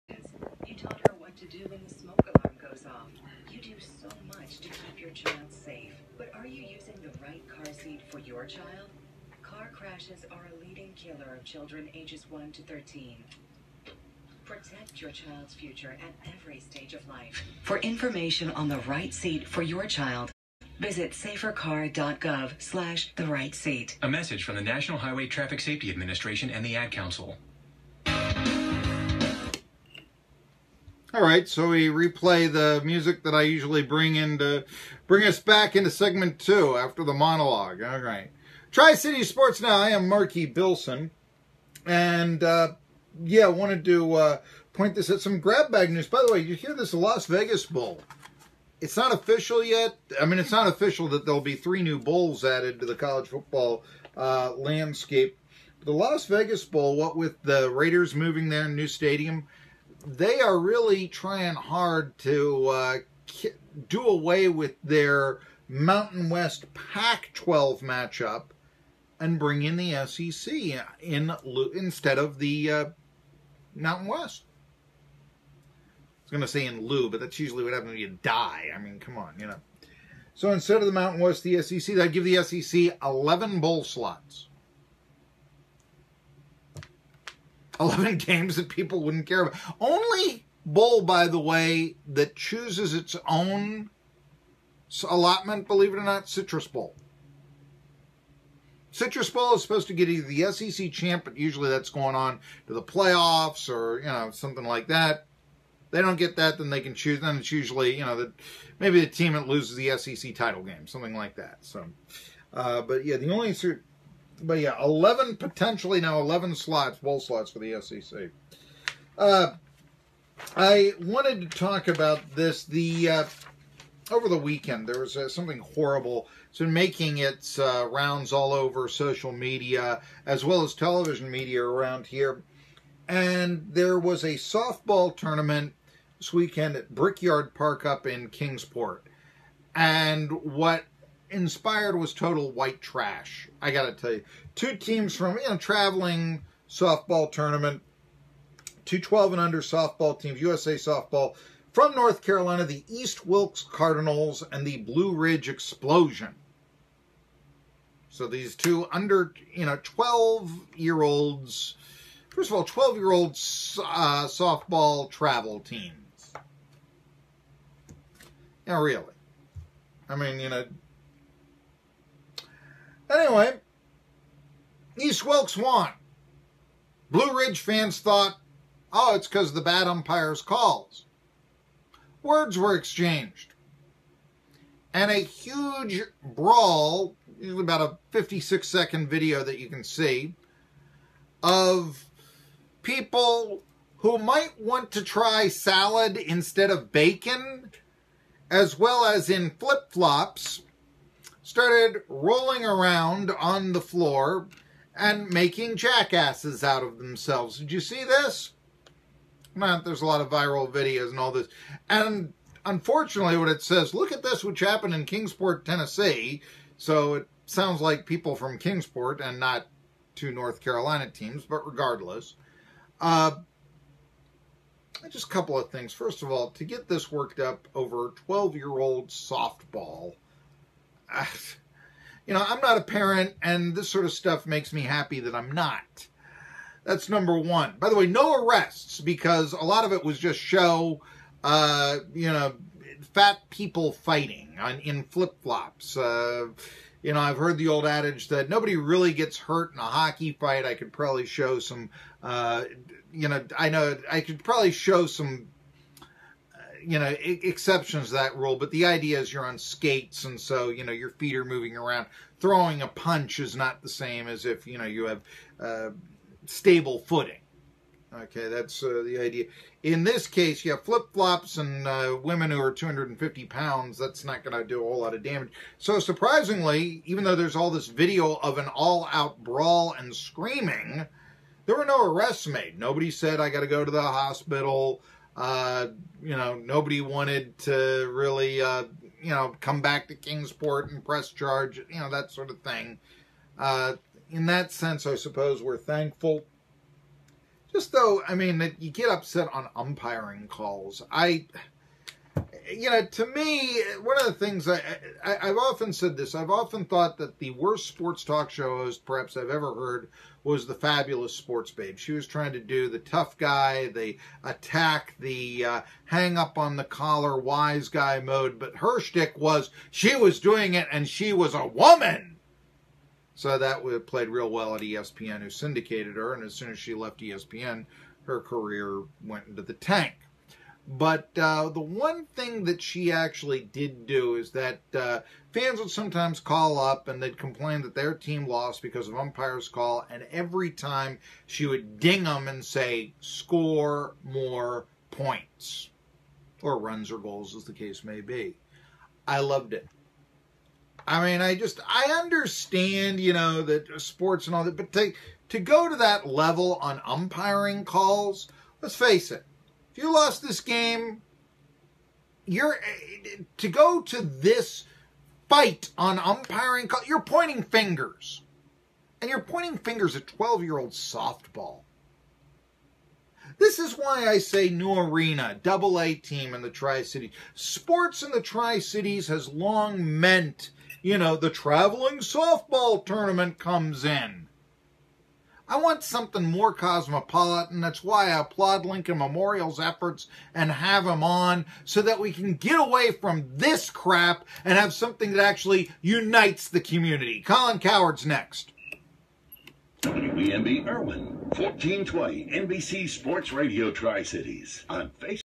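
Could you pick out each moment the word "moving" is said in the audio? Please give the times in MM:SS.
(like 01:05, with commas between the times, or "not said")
00:58, 04:21.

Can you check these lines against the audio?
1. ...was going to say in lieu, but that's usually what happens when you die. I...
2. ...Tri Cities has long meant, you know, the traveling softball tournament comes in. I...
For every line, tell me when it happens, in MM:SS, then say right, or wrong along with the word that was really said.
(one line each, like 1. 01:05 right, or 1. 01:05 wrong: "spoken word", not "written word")
1. 01:16 right
2. 06:18 right.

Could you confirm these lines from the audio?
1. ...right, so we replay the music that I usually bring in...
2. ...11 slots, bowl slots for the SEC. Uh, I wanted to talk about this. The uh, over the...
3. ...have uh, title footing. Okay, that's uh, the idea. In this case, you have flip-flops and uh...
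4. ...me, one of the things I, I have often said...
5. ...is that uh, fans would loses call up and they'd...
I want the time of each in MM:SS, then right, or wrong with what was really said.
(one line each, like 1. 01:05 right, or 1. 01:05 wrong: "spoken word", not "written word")
1. 00:31 right
2. 01:56 right
3. 04:25 wrong: "stable", not "title"
4. 05:03 right
5. 05:34 wrong: "sometimes", not "loses".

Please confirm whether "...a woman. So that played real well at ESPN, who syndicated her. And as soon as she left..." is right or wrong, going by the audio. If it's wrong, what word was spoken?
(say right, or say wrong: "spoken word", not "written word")
right.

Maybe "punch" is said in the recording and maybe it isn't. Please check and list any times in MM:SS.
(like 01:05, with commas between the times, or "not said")
04:22.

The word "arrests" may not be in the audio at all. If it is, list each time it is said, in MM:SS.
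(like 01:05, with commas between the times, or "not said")
03:58, 04:42.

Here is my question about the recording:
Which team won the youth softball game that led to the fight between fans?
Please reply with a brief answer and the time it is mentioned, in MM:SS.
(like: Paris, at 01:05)
East Wilkes Cardinals, at 02:54.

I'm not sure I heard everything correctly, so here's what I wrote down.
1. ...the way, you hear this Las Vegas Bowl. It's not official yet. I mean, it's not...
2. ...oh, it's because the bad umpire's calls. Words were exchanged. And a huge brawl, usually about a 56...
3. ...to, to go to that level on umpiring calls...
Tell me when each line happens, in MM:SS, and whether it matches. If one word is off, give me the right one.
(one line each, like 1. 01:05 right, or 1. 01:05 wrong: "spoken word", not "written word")
1. 00:46 right
2. 02:58 right
3. 05:54 right.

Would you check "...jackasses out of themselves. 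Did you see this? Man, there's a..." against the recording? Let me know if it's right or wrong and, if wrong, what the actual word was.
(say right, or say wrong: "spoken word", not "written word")
right.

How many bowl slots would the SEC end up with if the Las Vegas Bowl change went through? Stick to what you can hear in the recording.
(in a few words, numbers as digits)
11.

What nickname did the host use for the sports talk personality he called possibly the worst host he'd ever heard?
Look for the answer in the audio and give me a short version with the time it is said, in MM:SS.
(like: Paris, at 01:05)
the fabulous sports babe, at 05:10.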